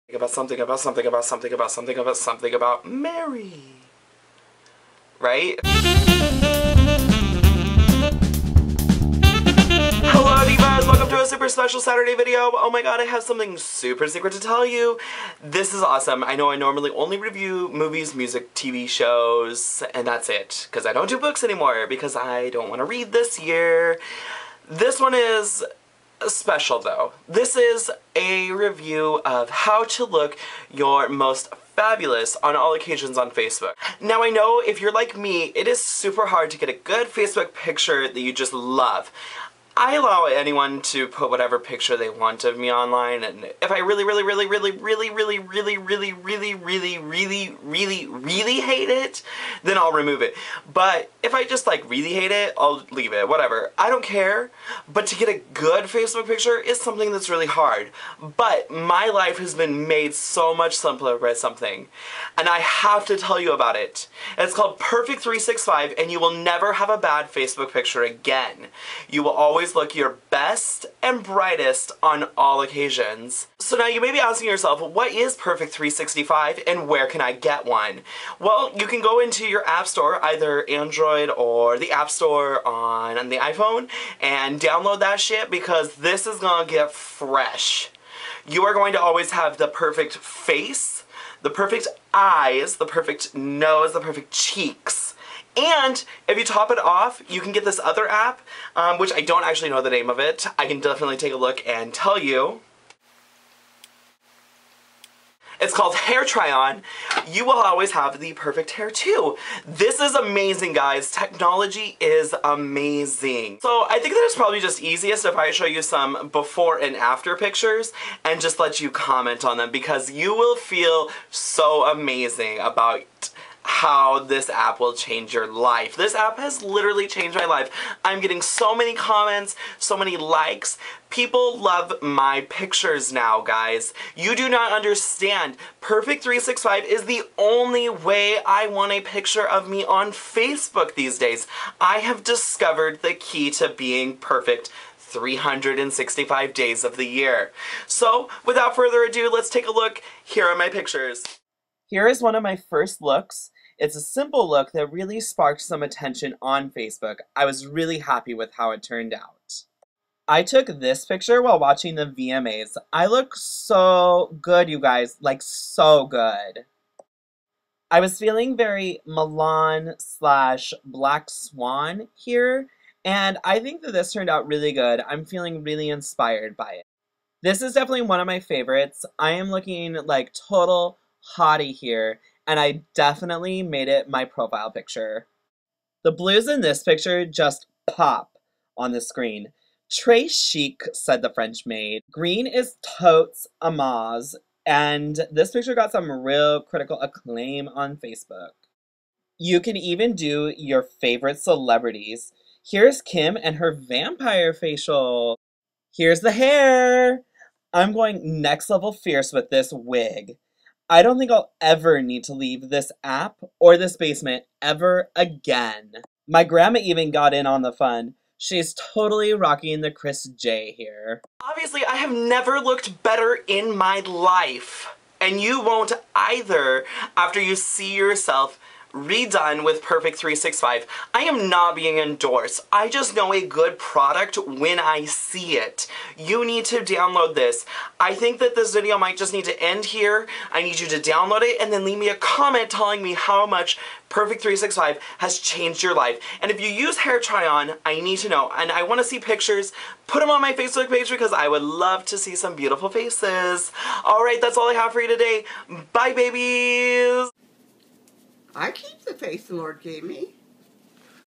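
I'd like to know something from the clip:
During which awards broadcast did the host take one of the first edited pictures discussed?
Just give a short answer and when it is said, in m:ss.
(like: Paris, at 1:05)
VMAs, at 2:42.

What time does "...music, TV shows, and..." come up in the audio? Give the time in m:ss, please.
0:18.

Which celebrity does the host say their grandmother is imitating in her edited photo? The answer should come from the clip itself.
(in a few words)
Kris J.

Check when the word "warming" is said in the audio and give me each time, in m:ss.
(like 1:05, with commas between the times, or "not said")
not said.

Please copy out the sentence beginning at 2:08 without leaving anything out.
I'm getting so many comments, so many likes.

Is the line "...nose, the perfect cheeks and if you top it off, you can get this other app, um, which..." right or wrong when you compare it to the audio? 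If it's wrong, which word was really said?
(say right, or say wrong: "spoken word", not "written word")
right.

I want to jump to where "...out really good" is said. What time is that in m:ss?
2:54.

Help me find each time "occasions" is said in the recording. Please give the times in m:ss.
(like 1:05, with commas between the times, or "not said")
0:32, 1:12.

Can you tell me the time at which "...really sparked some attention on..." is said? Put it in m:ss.
2:34.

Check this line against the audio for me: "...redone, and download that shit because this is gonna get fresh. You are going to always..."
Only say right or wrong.
wrong.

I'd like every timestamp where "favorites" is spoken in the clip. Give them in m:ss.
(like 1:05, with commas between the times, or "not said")
2:58, 3:20.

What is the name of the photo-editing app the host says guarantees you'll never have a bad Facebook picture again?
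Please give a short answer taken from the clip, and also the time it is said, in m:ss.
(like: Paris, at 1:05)
Perfect 365, at 1:04.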